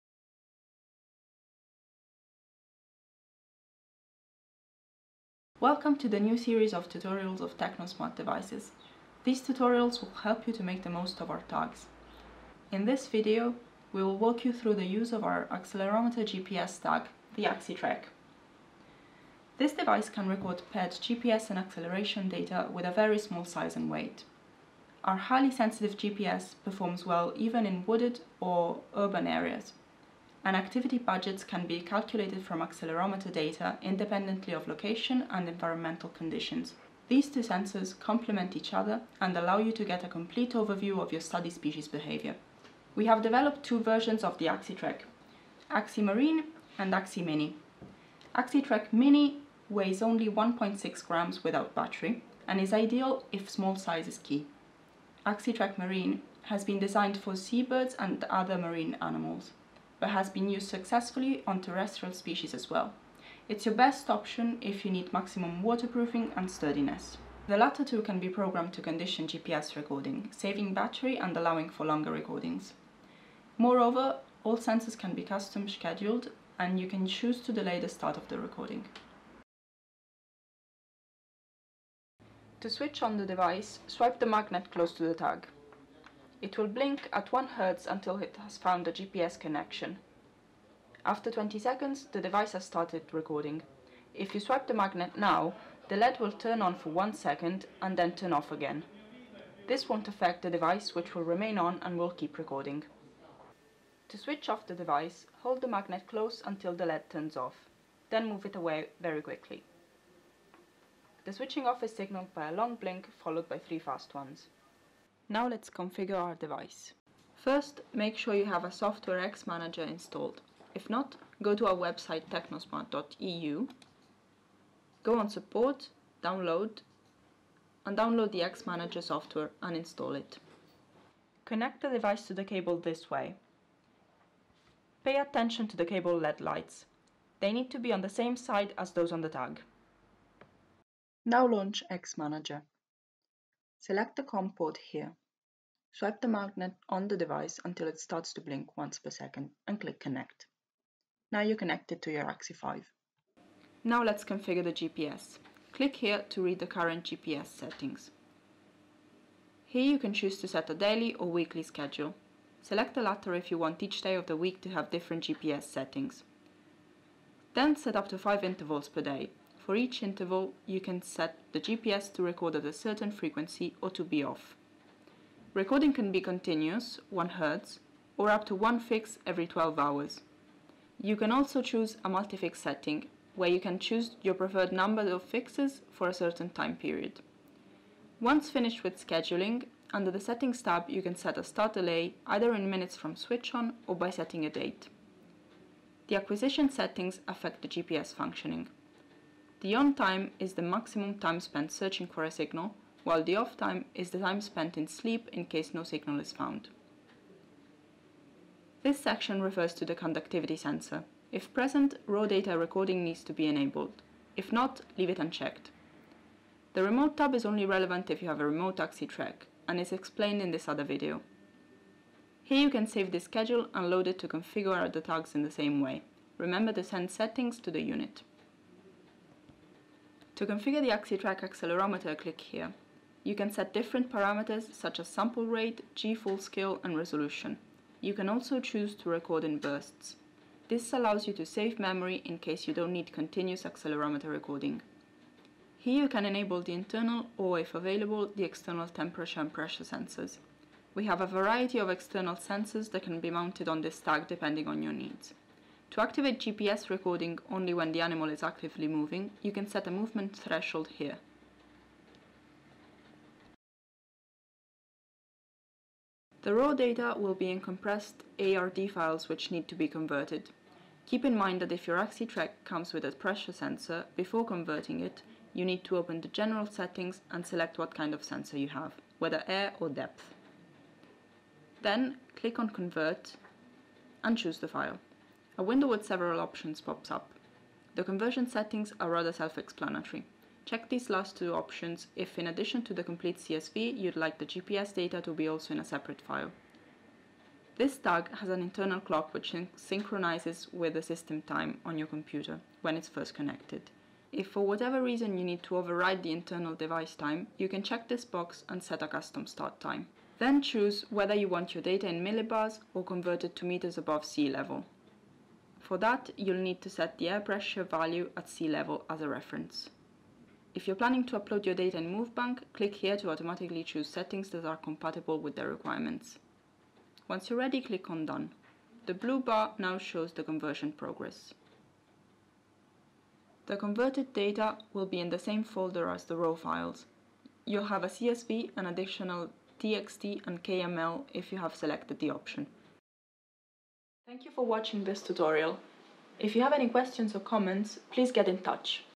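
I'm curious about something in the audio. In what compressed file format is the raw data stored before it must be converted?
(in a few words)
ARD.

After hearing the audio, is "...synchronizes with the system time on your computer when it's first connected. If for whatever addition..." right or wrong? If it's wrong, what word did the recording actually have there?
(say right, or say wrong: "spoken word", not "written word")
wrong: "reason", not "addition".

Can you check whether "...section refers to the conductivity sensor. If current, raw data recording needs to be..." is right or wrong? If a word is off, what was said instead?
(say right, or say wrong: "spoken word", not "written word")
wrong: "present", not "current".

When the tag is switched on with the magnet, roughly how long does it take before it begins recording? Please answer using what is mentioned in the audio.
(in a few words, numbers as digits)
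20 seconds.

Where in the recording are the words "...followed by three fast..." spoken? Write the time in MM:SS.
01:53.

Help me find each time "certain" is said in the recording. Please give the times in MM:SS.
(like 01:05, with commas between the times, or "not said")
02:52, 03:06.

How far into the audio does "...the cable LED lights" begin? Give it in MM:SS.
02:15.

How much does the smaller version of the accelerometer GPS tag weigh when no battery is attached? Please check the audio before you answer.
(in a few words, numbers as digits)
1.6 grams.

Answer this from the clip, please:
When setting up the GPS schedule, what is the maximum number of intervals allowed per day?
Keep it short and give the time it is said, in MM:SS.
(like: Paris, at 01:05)
5, at 02:48.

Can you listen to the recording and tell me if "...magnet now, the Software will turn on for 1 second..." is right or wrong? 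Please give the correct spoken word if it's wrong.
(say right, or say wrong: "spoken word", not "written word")
wrong: "LED", not "Software".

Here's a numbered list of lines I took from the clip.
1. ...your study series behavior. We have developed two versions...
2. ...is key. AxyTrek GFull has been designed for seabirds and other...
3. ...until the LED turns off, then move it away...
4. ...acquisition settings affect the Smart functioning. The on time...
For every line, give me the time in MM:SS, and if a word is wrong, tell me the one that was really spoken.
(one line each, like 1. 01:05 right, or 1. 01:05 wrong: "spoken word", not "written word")
1. 00:41 wrong: "species", not "series"
2. 00:54 wrong: "Marine", not "GFull"
3. 01:46 right
4. 03:16 wrong: "GPS", not "Smart".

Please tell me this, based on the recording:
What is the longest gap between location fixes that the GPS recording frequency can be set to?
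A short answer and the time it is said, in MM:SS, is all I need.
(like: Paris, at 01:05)
12 hours, at 02:59.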